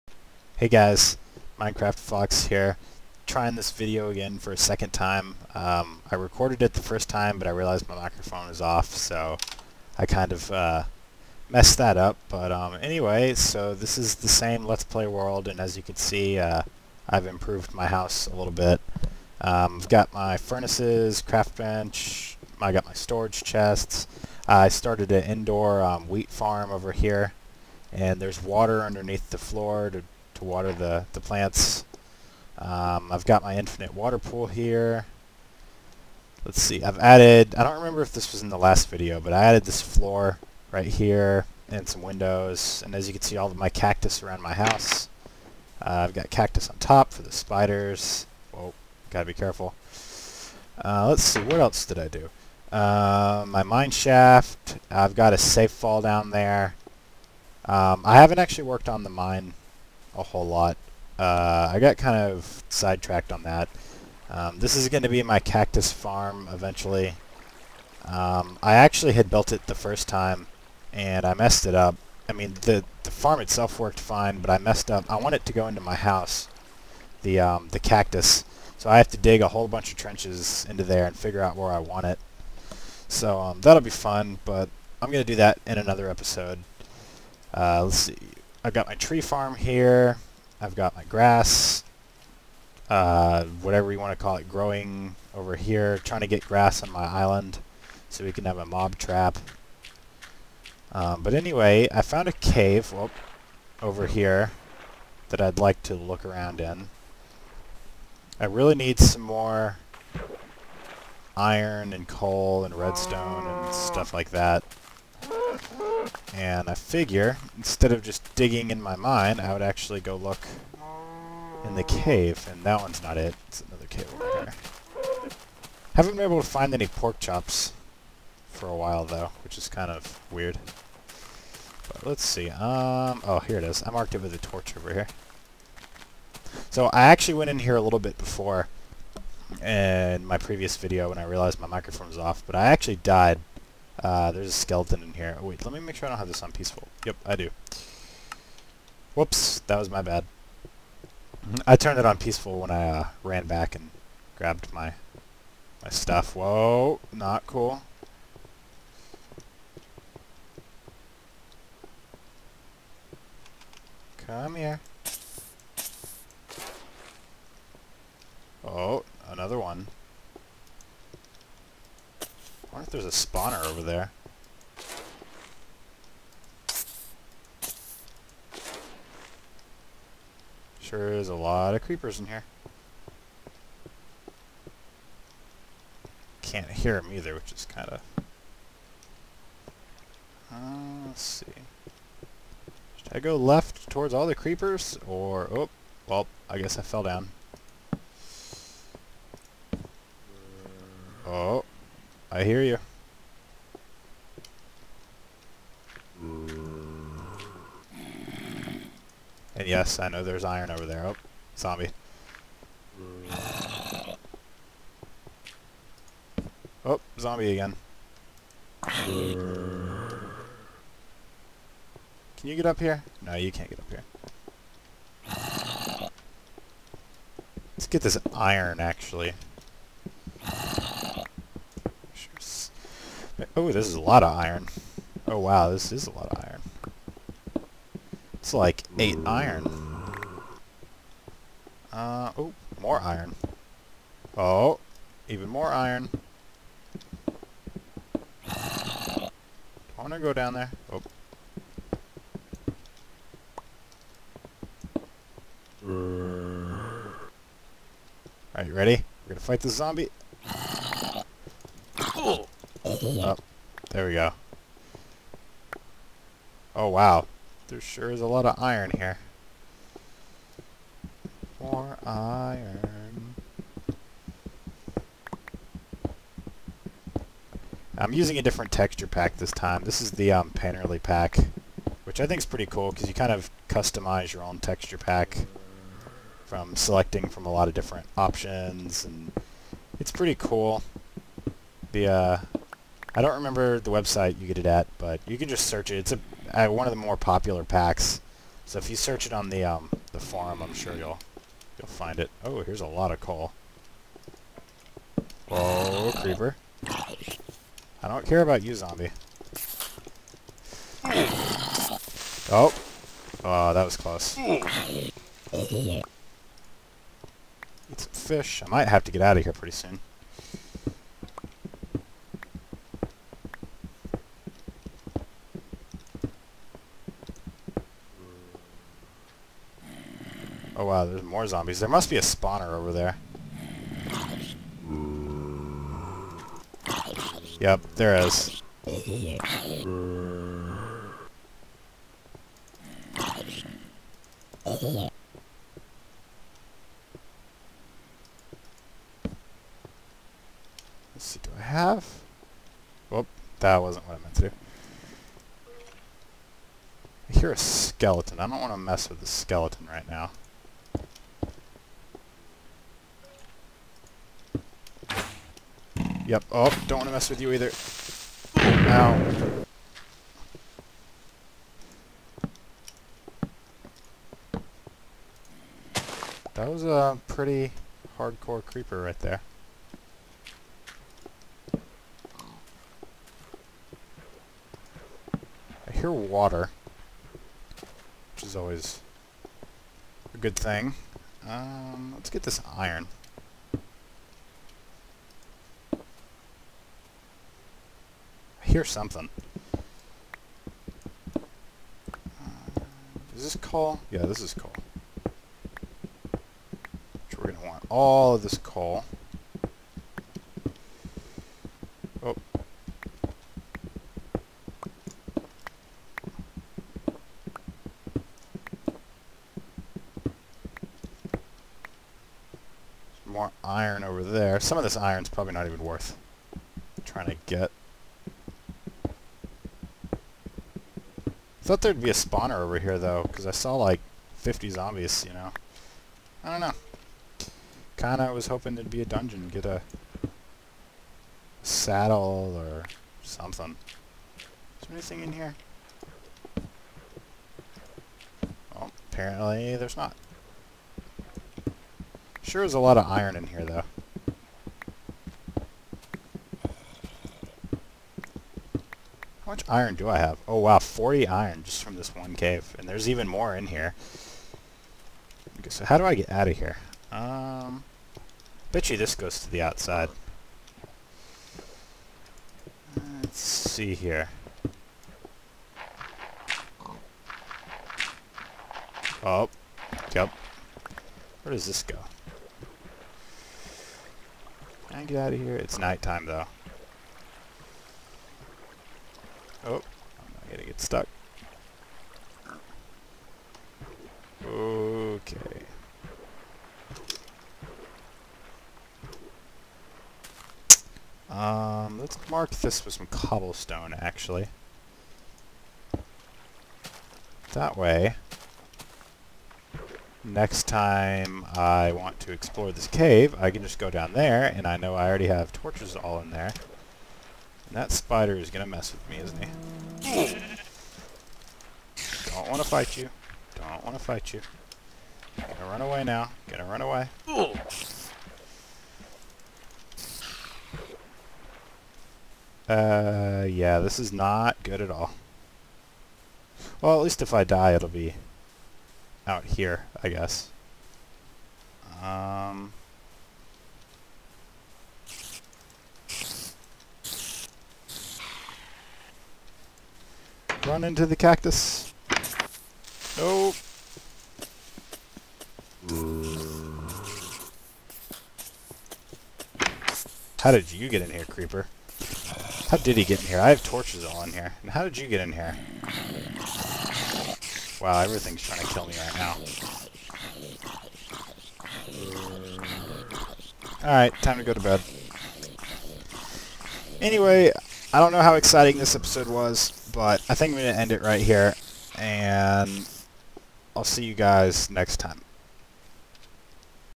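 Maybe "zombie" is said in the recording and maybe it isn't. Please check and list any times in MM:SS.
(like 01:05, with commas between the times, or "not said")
03:31, 03:37, 04:19, 05:08, 05:31, 07:14.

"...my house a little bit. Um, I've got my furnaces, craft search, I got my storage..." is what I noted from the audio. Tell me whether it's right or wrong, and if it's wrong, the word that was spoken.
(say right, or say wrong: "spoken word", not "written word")
wrong: "bench", not "search".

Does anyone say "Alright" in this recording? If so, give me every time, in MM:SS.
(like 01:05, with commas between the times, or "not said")
04:18, 09:33.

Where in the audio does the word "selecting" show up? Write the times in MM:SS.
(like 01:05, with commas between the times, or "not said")
04:46.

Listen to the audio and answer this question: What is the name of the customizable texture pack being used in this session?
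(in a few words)
Painterly.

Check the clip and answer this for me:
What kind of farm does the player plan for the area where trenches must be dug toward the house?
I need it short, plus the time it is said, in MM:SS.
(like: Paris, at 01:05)
Cactus farm, at 01:05.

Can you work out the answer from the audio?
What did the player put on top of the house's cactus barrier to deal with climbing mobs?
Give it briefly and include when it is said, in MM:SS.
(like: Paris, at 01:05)
Spiders, at 00:46.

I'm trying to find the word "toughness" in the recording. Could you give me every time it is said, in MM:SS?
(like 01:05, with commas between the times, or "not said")
not said.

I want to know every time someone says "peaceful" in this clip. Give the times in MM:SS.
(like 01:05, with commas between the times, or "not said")
02:26, 02:32.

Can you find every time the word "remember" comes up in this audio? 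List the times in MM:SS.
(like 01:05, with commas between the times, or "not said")
00:37, 04:53.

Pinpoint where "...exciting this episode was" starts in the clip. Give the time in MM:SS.
09:38.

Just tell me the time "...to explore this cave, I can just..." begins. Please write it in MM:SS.
08:32.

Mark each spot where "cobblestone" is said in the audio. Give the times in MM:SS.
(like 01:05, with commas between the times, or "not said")
08:23.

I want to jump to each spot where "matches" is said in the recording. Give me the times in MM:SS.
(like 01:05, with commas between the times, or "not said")
not said.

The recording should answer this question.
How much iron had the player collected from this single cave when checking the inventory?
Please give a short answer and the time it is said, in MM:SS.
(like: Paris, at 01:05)
40, at 07:40.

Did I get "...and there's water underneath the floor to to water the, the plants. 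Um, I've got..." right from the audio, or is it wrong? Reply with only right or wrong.
right.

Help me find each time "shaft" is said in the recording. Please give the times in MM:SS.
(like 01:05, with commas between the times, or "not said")
00:53.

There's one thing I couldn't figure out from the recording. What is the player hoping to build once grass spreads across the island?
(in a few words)
A mob trap.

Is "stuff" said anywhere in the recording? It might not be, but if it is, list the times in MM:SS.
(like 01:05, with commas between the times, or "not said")
01:53, 02:35.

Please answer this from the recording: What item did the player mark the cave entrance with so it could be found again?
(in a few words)
A torch.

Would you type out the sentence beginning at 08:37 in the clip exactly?
That spider is gonna mess with me, isn't he?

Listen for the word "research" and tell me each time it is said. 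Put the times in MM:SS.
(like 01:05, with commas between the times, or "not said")
not said.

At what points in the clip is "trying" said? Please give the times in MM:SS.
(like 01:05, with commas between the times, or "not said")
00:03, 01:35, 07:07, 09:28.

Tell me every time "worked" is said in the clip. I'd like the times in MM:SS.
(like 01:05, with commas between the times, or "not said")
00:58, 01:13.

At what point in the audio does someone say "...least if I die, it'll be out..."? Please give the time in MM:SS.
08:57.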